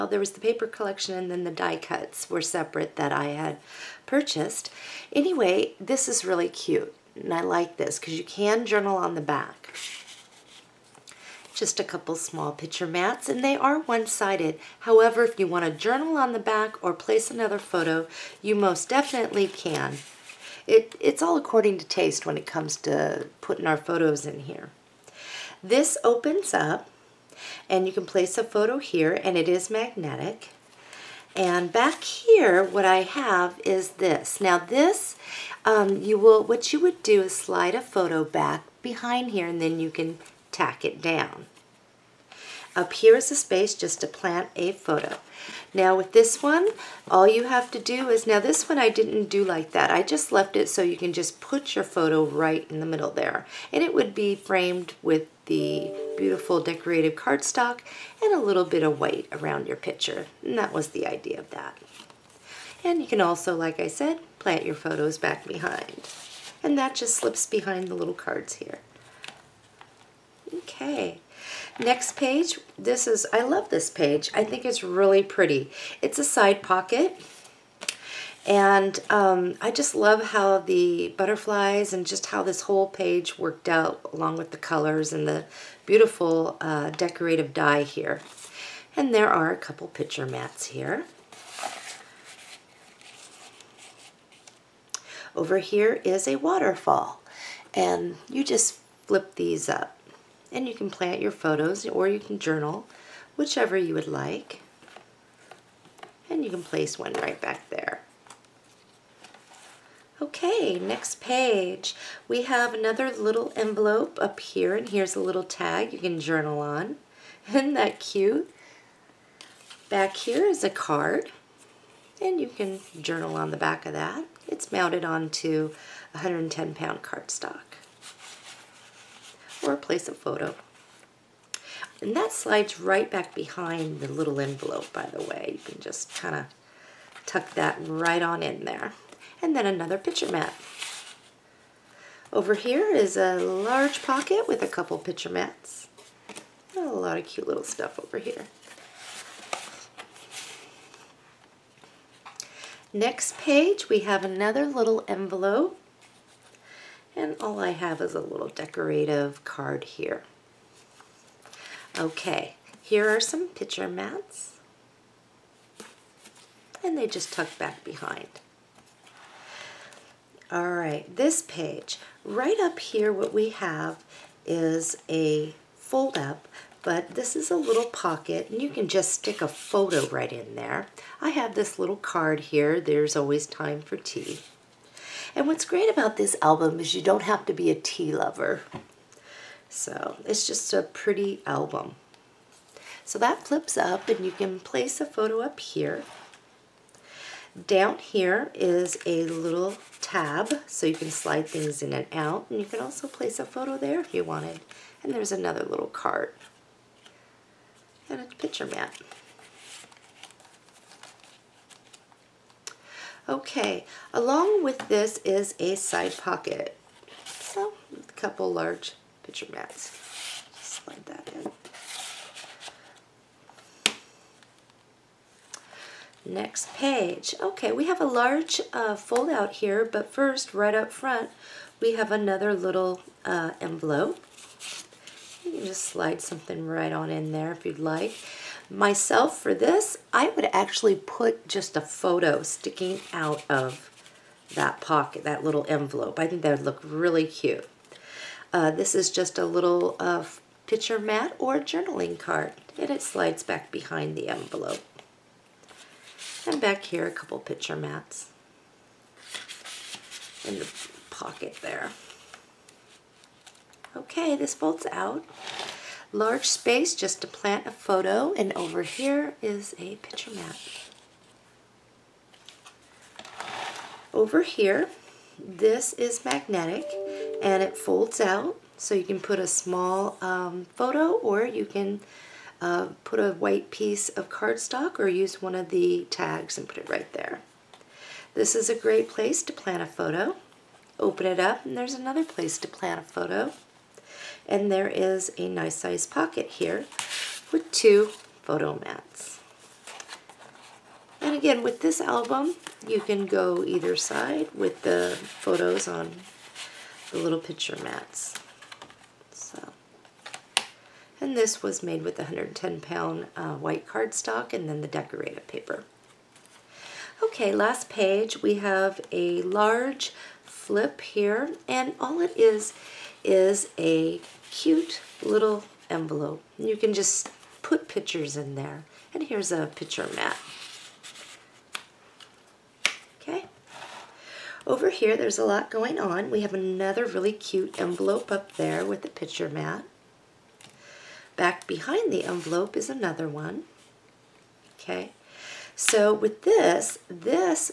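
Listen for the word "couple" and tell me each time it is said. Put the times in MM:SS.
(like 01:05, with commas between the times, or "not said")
00:11, 01:29, 02:24, 03:38, 04:17.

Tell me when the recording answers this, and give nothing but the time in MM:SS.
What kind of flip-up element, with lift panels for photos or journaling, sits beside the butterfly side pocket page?
01:36.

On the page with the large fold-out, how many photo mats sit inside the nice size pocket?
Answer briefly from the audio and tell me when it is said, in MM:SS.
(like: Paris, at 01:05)
2, at 04:57.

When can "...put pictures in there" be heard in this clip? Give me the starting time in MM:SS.
05:27.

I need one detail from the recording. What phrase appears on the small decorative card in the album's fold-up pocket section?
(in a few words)
There's Always Time for Tea.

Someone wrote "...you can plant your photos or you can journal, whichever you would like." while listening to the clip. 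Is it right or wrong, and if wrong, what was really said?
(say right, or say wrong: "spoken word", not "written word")
right.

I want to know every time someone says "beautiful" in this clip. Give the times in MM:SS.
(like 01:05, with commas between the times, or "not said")
00:56, 01:25.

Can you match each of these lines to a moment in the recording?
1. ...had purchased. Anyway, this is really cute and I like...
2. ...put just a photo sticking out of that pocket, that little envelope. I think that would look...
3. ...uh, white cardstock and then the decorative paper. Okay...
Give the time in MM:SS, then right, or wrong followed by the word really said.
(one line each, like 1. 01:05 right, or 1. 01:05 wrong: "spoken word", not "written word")
1. 00:03 right
2. 04:00 right
3. 05:13 right.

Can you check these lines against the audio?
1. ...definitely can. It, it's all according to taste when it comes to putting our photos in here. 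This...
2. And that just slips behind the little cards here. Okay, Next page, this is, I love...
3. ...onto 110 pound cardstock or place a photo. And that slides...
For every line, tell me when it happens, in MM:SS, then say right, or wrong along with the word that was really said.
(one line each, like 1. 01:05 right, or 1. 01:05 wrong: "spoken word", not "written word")
1. 00:18 right
2. 01:06 right
3. 02:05 right.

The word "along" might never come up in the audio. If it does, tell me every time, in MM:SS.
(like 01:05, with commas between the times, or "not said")
01:24, 03:34.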